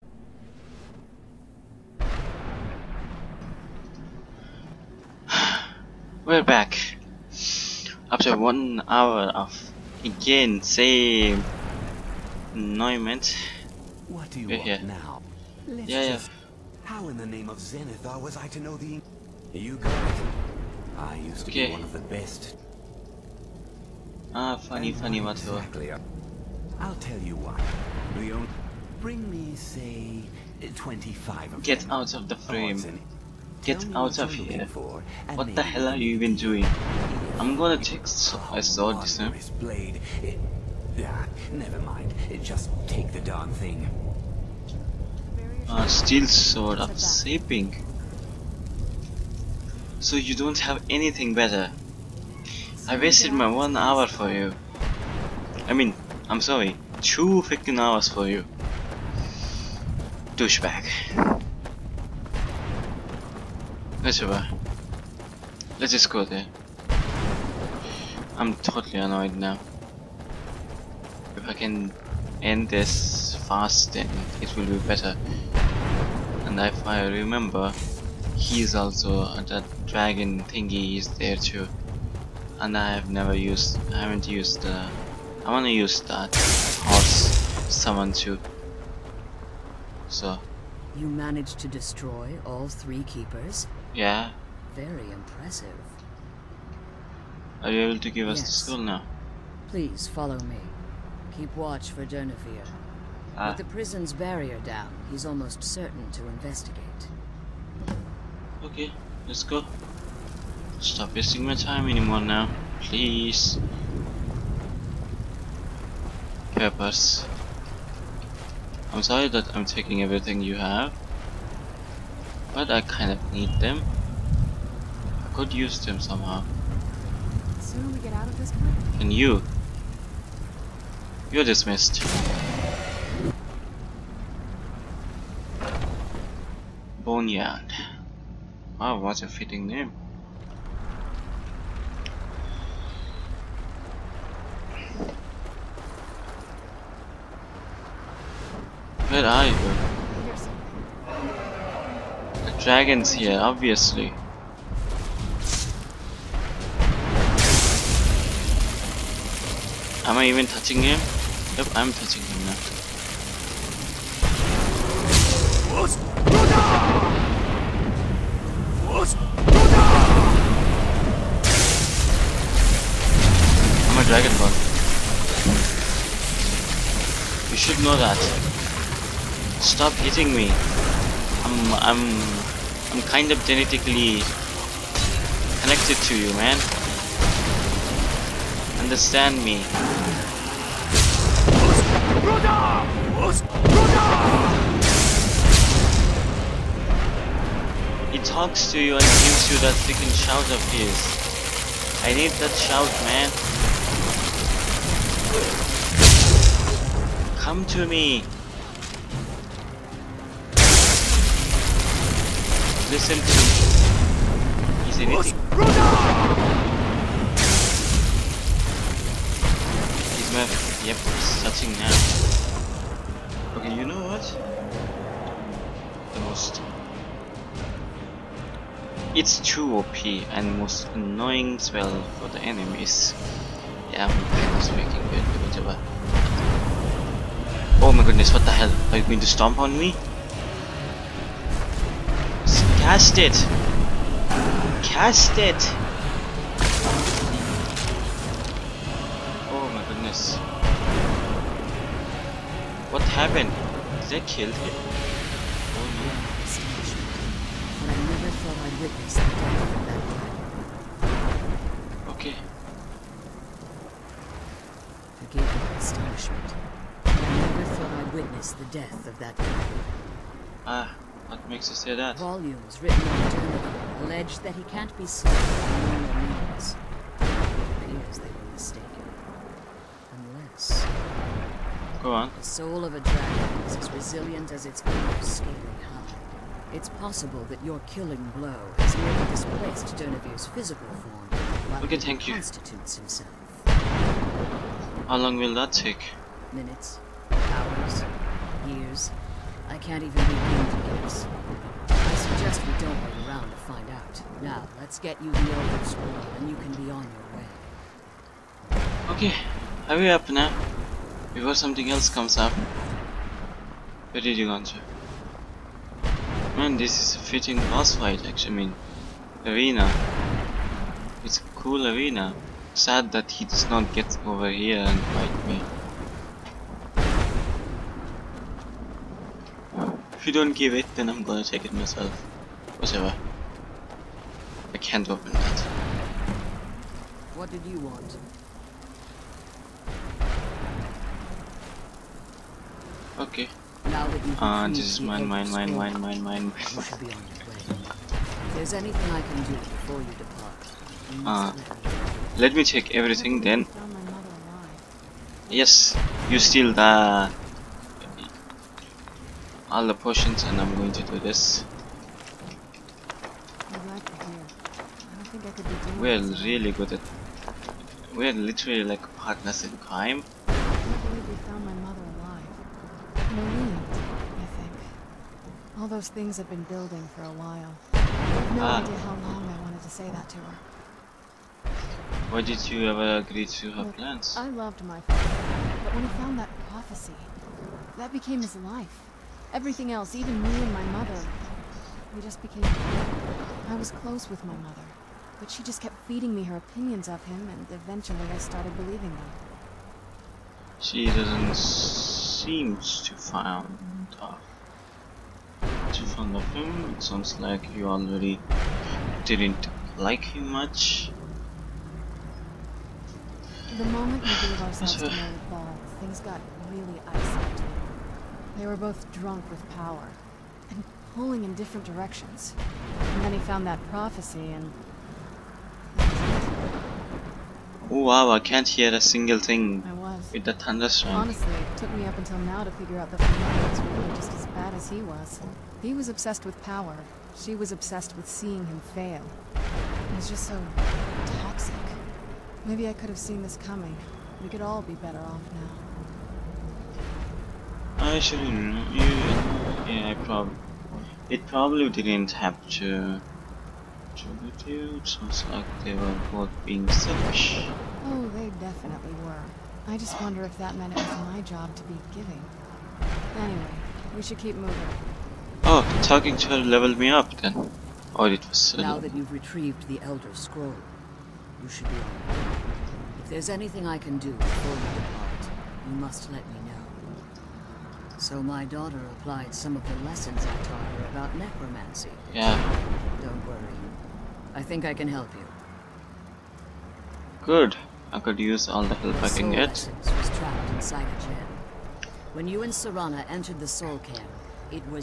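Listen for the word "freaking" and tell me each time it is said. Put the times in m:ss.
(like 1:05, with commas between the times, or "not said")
0:57, 3:19.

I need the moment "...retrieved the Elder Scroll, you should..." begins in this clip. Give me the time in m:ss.
7:49.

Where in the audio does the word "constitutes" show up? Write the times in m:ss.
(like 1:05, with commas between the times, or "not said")
4:52.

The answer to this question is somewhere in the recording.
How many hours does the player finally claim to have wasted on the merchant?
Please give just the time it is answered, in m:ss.
0:57.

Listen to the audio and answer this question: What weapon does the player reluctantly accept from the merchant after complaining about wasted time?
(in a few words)
Steel sword.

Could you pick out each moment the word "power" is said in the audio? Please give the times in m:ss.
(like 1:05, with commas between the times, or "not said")
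6:59, 7:16.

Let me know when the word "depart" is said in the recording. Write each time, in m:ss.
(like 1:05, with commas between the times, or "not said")
5:50, 7:55.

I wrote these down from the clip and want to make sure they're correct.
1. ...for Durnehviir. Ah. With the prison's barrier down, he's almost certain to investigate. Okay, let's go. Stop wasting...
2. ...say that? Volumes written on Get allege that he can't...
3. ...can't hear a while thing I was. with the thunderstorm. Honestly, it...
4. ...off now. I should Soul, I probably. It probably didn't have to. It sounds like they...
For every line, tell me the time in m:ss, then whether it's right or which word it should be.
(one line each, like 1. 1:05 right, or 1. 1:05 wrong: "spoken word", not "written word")
1. 1:41 right
2. 4:31 wrong: "Durnehviir", not "Get"
3. 7:08 wrong: "single", not "while"
4. 7:25 wrong: "Yeah", not "Soul".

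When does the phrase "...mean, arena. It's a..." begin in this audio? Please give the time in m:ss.
5:18.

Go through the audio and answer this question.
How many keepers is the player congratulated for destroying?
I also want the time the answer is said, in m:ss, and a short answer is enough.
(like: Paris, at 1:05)
3, at 1:32.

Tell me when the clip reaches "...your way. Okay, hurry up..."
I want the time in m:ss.
5:07.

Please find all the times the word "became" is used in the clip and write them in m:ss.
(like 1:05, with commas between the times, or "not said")
6:28, 6:32.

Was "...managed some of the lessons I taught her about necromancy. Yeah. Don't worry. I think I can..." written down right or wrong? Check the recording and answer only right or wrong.
wrong.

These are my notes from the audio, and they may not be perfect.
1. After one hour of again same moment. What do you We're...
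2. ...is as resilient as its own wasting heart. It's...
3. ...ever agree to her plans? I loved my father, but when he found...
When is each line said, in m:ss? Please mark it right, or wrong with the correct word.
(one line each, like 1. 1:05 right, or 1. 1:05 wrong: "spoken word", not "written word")
1. 0:08 wrong: "annoyment", not "moment"
2. 4:43 wrong: "scaling", not "wasting"
3. 6:22 right.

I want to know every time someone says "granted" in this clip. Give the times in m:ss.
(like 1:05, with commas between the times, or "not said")
not said.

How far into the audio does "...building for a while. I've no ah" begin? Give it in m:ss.
6:16.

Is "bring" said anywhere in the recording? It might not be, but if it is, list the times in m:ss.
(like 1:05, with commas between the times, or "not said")
0:28.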